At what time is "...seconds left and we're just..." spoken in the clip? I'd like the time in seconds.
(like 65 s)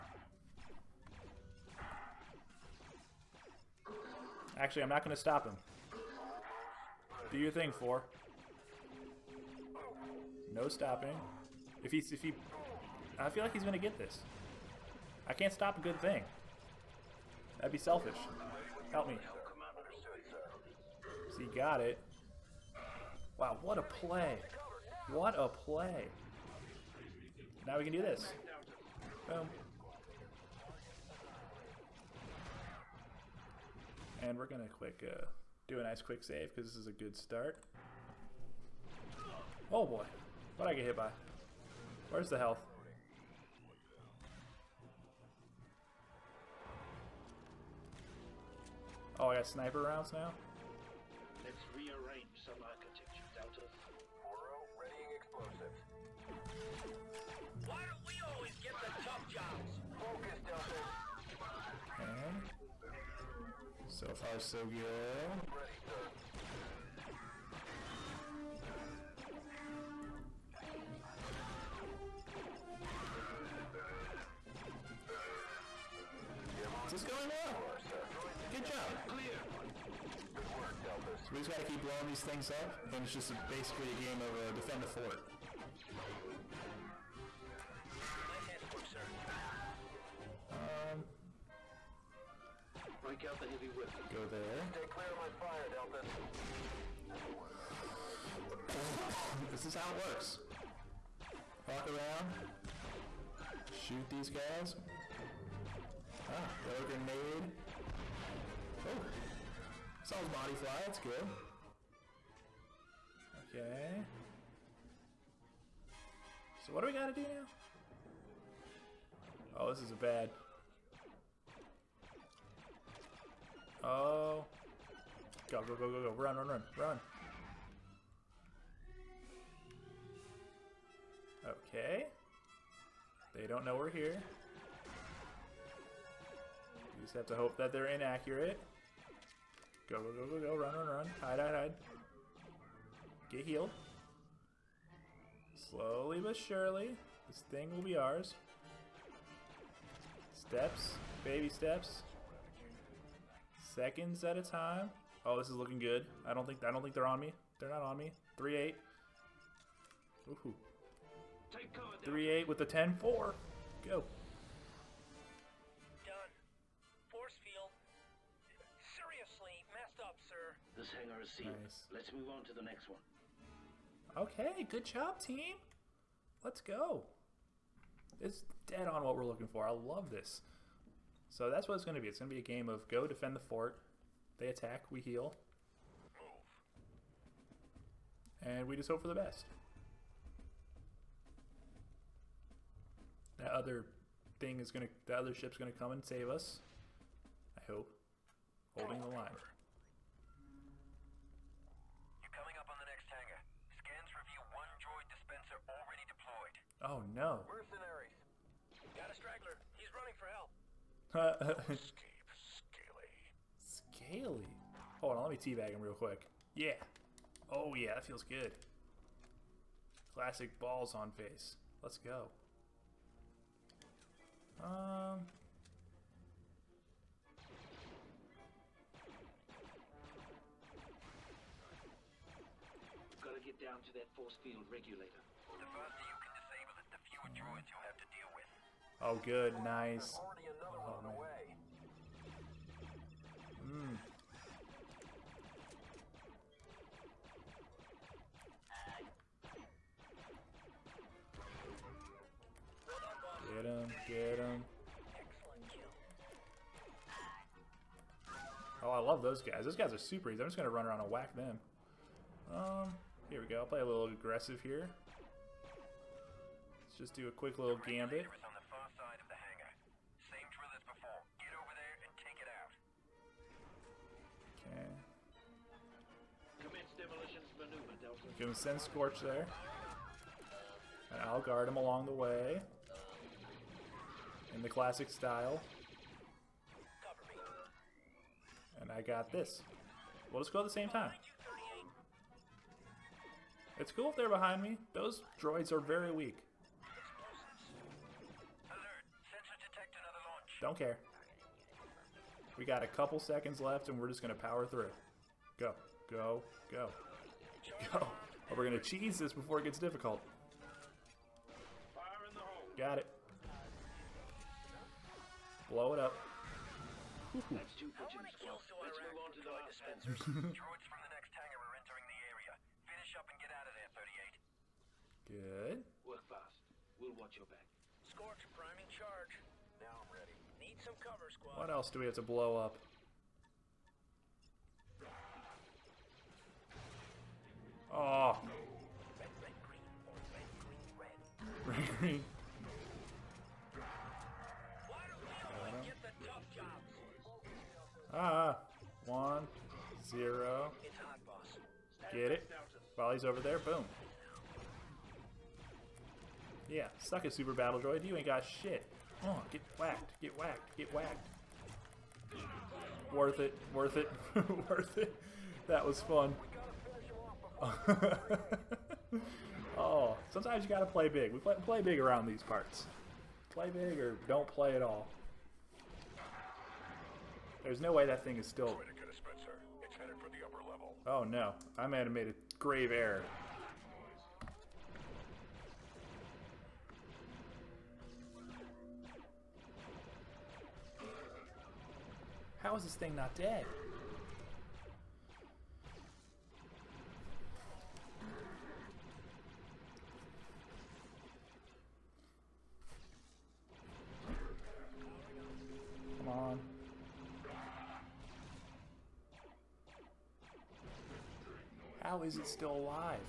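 303 s.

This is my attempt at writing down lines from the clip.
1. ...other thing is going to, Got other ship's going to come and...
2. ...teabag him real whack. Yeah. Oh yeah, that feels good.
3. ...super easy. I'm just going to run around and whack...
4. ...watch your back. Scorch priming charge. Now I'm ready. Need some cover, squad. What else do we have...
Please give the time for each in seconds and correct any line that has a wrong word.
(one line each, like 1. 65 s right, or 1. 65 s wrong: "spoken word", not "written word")
1. 193 s wrong: "That", not "Got"
2. 215 s wrong: "quick", not "whack"
3. 259 s right
4. 327 s right.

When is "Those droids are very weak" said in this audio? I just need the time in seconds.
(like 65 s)
294 s.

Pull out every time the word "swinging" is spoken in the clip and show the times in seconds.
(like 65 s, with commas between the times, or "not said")
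not said.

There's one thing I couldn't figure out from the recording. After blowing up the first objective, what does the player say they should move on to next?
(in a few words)
the dispensers.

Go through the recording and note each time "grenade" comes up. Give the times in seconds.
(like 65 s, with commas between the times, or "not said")
106 s.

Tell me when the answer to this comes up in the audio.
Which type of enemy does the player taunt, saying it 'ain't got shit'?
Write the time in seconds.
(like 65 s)
357 s.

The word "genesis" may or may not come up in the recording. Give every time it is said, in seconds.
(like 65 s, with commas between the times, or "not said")
not said.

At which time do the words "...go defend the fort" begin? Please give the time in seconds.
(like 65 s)
182 s.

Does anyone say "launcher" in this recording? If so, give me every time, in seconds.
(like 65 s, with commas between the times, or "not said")
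not said.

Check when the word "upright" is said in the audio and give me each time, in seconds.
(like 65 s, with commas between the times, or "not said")
not said.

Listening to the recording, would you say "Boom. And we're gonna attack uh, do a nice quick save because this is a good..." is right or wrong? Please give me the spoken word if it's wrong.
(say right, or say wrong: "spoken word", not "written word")
wrong: "quick", not "attack".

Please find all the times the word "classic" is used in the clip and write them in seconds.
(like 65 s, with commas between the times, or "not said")
220 s, 284 s.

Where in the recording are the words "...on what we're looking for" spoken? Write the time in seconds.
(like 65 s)
178 s.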